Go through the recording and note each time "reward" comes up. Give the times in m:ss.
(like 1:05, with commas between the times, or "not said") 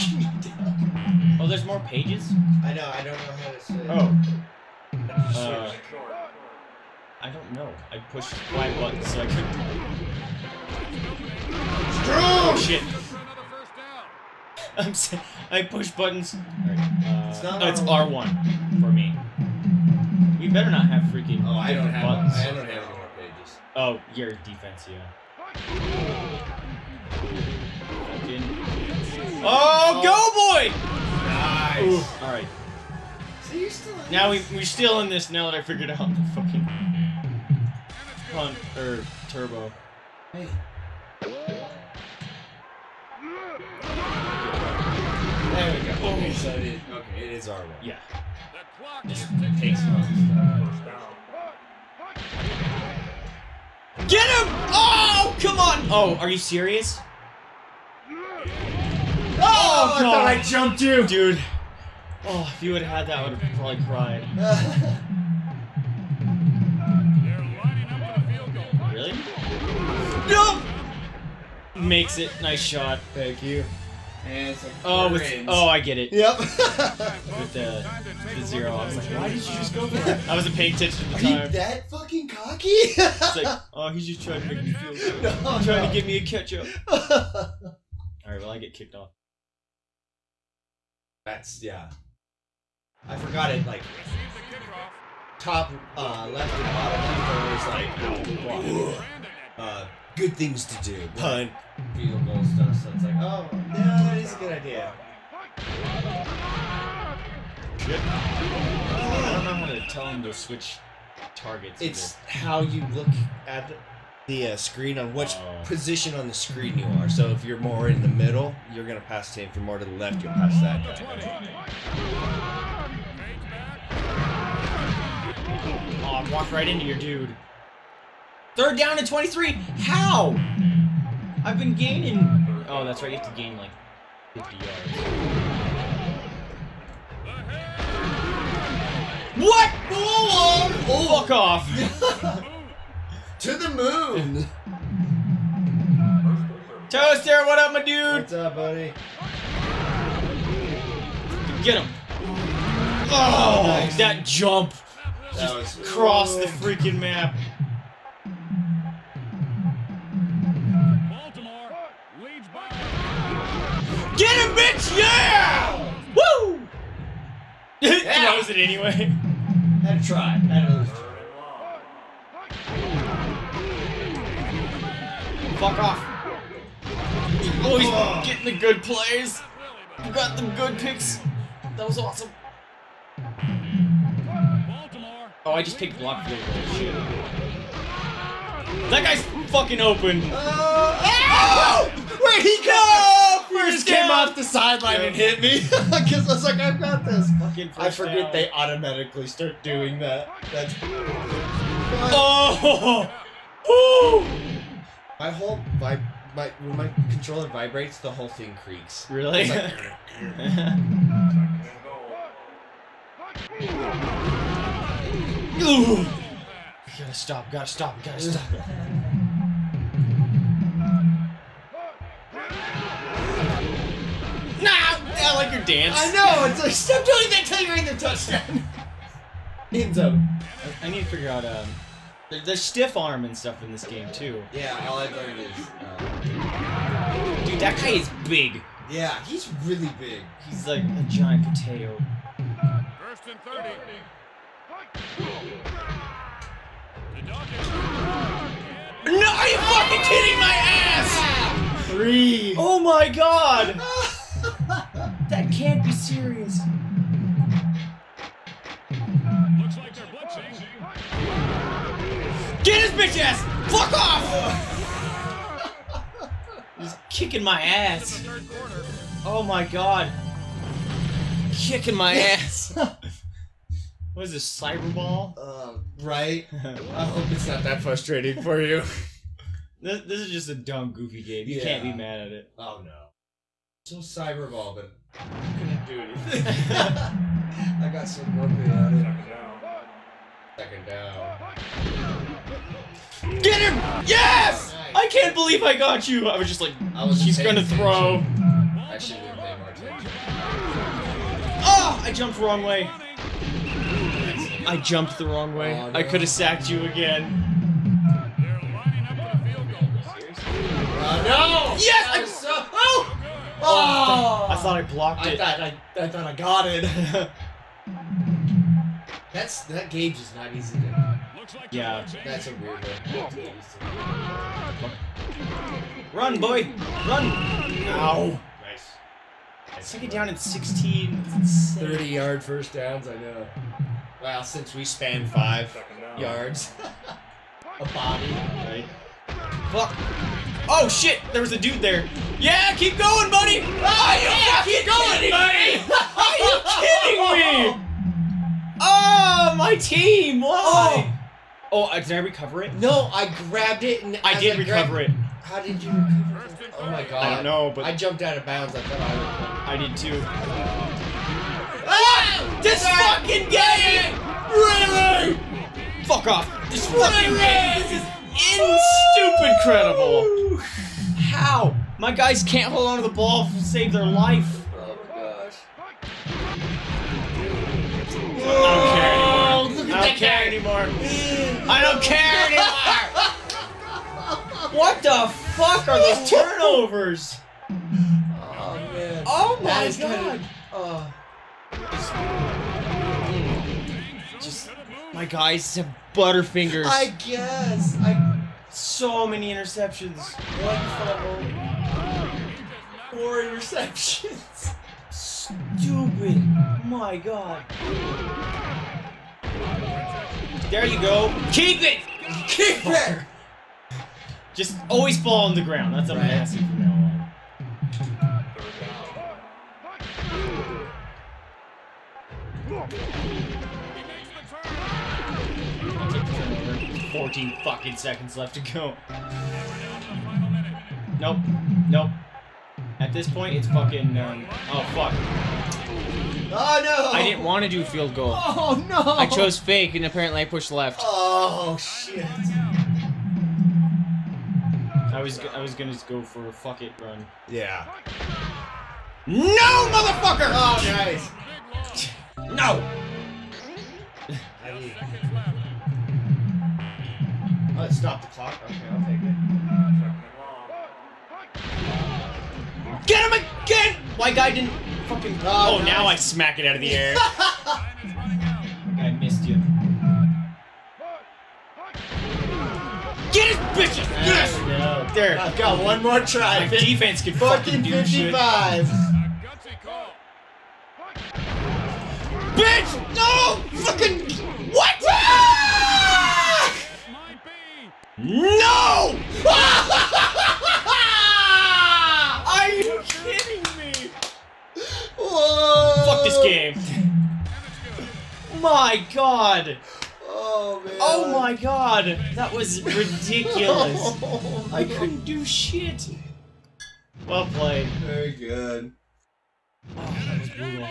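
not said.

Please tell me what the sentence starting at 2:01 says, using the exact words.
20, Oh, walk right into your dude.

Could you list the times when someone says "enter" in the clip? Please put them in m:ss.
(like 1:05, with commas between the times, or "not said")
not said.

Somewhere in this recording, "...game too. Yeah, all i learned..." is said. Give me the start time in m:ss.
3:53.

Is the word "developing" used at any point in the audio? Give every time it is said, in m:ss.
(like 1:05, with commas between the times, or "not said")
not said.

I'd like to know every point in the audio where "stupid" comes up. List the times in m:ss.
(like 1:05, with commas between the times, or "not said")
6:09, 6:45.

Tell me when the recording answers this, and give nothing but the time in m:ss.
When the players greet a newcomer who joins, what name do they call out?
2:26.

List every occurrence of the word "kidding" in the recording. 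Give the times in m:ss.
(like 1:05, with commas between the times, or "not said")
4:10, 5:47, 8:13.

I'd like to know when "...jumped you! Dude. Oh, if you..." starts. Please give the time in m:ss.
1:00.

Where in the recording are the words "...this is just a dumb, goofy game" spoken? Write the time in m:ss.
4:40.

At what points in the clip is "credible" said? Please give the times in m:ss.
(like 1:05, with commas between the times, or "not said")
6:09.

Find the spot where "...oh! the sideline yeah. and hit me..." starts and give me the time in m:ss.
3:10.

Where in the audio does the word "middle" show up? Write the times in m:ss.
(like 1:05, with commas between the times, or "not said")
1:58.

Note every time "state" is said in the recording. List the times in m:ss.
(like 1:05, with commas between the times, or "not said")
not said.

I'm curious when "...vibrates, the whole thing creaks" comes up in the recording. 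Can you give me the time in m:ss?
3:27.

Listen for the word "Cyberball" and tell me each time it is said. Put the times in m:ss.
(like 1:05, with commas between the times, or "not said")
4:34, 4:43.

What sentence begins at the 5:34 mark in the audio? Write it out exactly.
Wow, since we span five yards.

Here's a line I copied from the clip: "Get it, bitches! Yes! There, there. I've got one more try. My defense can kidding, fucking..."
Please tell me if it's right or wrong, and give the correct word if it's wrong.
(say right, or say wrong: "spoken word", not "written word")
wrong: "fucking", not "kidding".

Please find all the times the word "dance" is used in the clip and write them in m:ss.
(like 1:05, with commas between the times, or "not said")
3:45.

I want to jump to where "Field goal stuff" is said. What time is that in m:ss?
1:41.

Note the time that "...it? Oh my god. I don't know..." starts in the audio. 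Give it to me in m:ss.
5:56.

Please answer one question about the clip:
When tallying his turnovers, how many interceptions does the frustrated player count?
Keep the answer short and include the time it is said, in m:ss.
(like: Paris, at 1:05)
4, at 6:43.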